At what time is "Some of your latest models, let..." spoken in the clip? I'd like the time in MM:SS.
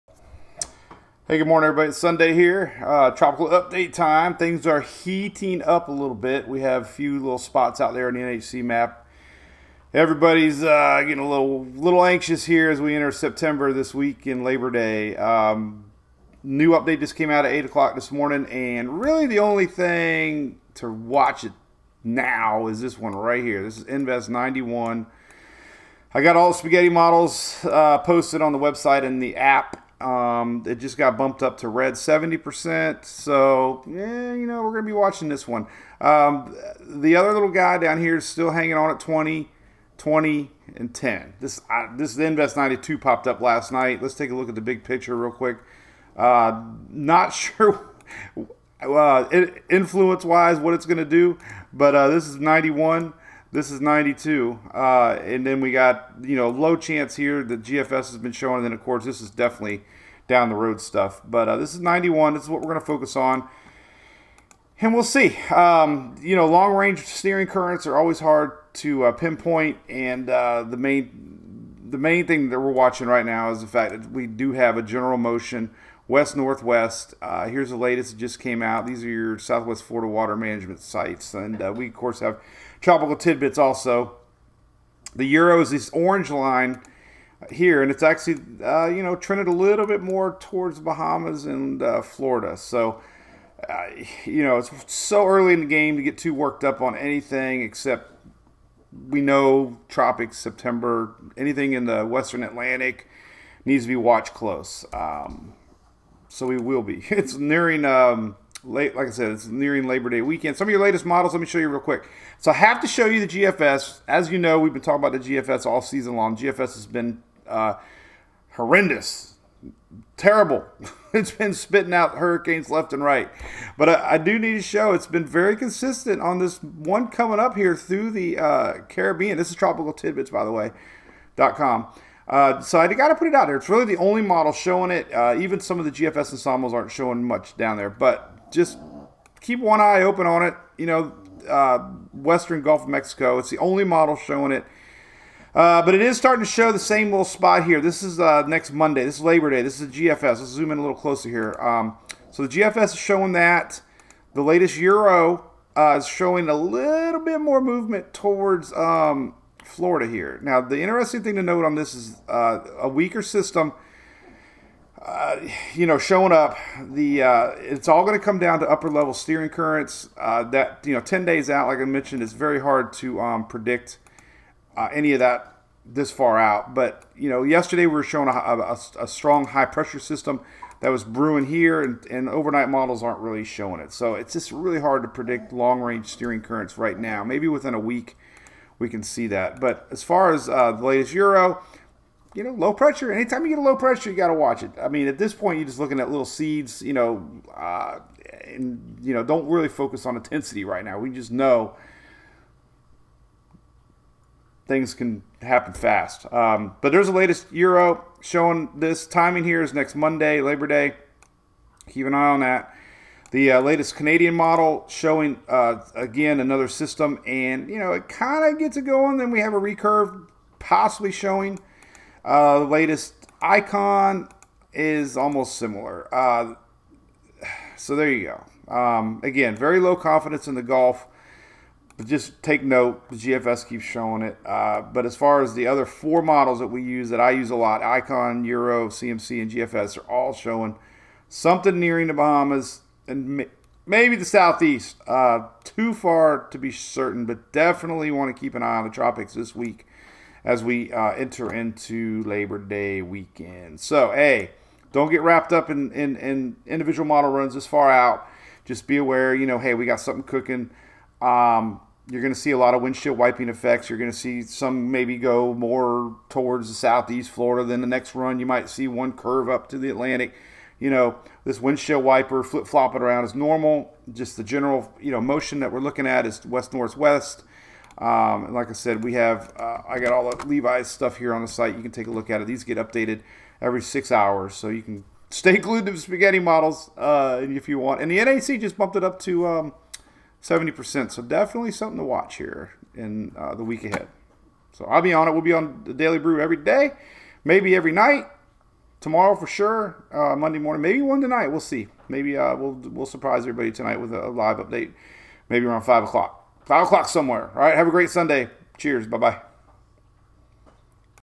01:50.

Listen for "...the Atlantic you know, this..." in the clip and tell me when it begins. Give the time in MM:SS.
04:29.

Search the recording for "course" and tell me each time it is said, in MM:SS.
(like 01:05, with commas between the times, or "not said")
00:58, 01:21.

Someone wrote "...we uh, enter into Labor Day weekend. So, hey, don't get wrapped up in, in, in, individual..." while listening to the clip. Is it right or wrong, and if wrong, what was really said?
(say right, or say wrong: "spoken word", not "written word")
right.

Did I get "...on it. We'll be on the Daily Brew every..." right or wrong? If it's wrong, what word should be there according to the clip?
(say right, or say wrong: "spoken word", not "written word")
right.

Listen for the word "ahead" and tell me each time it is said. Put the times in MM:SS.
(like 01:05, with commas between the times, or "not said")
04:53.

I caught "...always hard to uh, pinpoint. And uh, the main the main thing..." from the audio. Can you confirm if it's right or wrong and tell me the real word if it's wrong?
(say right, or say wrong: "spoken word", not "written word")
right.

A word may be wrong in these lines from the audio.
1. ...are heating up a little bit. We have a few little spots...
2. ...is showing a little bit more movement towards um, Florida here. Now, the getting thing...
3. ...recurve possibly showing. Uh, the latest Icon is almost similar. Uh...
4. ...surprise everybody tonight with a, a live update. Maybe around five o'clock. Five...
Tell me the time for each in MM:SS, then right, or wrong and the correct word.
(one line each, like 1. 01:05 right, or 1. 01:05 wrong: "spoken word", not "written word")
1. 00:04 right
2. 02:35 wrong: "interesting", not "getting"
3. 03:39 right
4. 05:03 right.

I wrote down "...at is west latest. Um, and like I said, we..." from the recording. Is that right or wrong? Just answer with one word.
wrong.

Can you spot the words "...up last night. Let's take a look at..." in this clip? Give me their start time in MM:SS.
00:43.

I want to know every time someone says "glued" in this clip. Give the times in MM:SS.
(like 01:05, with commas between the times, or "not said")
04:45.